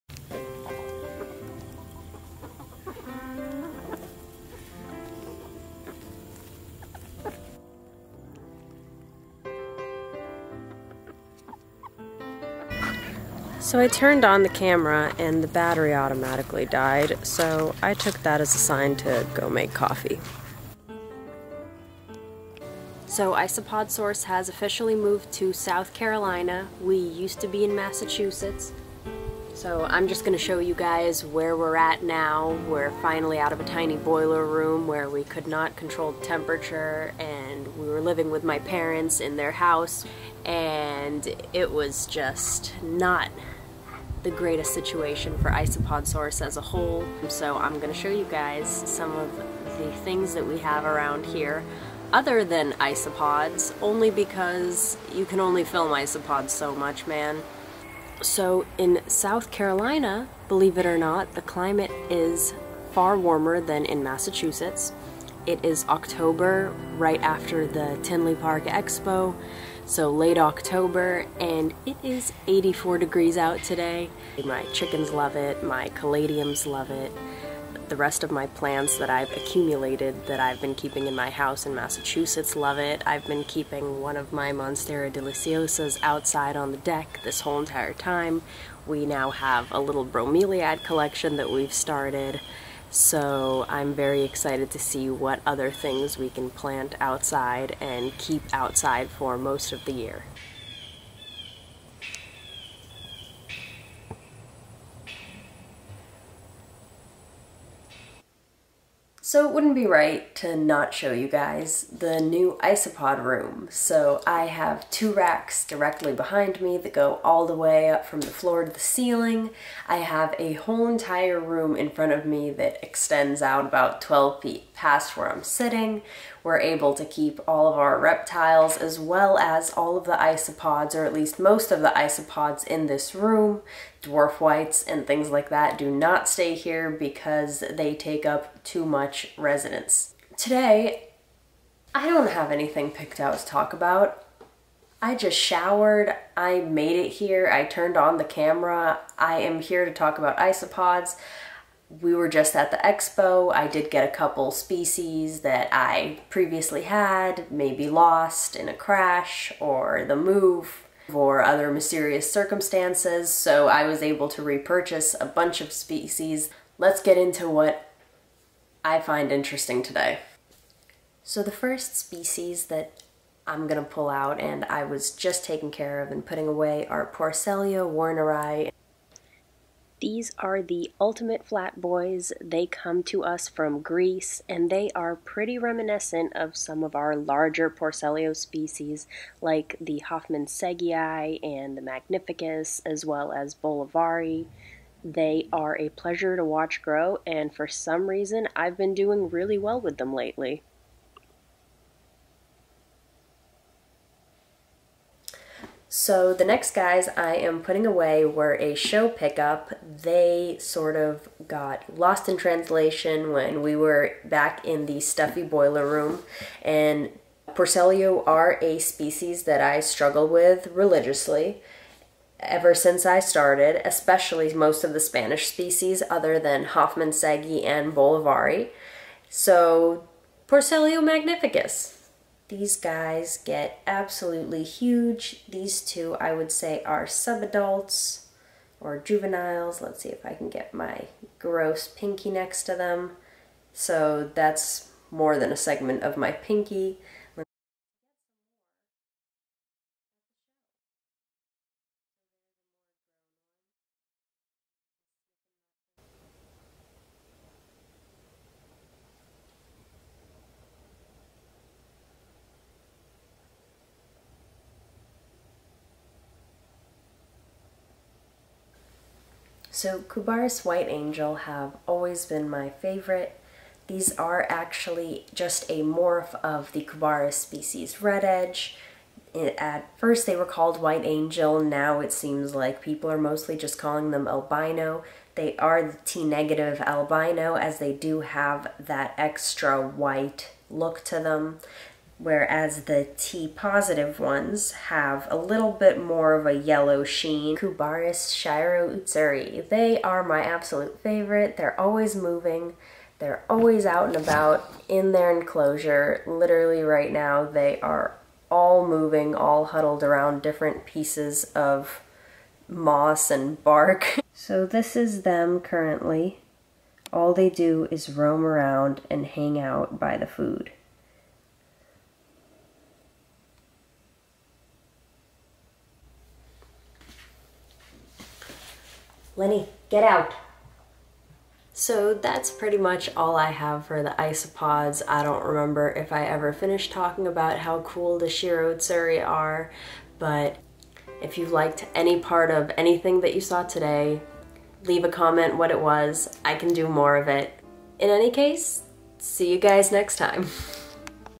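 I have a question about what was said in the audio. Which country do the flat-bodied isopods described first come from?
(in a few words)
Greece.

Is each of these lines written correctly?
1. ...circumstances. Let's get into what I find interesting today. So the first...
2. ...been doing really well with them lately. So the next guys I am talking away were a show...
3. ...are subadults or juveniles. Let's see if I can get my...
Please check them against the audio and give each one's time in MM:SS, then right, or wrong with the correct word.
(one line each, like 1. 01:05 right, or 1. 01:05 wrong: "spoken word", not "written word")
1. 02:45 wrong: "species", not "circumstances"
2. 03:18 wrong: "putting", not "talking"
3. 03:56 right.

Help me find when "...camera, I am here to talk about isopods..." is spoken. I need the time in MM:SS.
02:28.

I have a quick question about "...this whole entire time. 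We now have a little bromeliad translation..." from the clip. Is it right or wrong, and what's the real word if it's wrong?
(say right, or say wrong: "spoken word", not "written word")
wrong: "collection", not "translation".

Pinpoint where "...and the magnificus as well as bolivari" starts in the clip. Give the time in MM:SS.
03:11.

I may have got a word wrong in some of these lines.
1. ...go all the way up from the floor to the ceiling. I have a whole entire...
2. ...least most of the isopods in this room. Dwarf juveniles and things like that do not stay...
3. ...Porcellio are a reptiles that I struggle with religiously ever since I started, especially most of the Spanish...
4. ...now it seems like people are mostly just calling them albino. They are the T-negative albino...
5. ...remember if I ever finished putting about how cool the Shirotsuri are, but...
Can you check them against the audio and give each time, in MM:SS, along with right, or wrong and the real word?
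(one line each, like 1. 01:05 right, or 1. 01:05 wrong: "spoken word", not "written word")
1. 01:56 right
2. 02:11 wrong: "whites", not "juveniles"
3. 03:37 wrong: "species", not "reptiles"
4. 04:41 right
5. 05:35 wrong: "talking", not "putting".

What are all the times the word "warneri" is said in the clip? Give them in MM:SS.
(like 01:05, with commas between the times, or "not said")
02:57.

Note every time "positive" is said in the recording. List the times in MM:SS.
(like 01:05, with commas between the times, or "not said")
04:53.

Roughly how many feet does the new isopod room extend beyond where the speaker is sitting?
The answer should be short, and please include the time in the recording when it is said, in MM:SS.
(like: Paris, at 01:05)
12 feet, at 02:04.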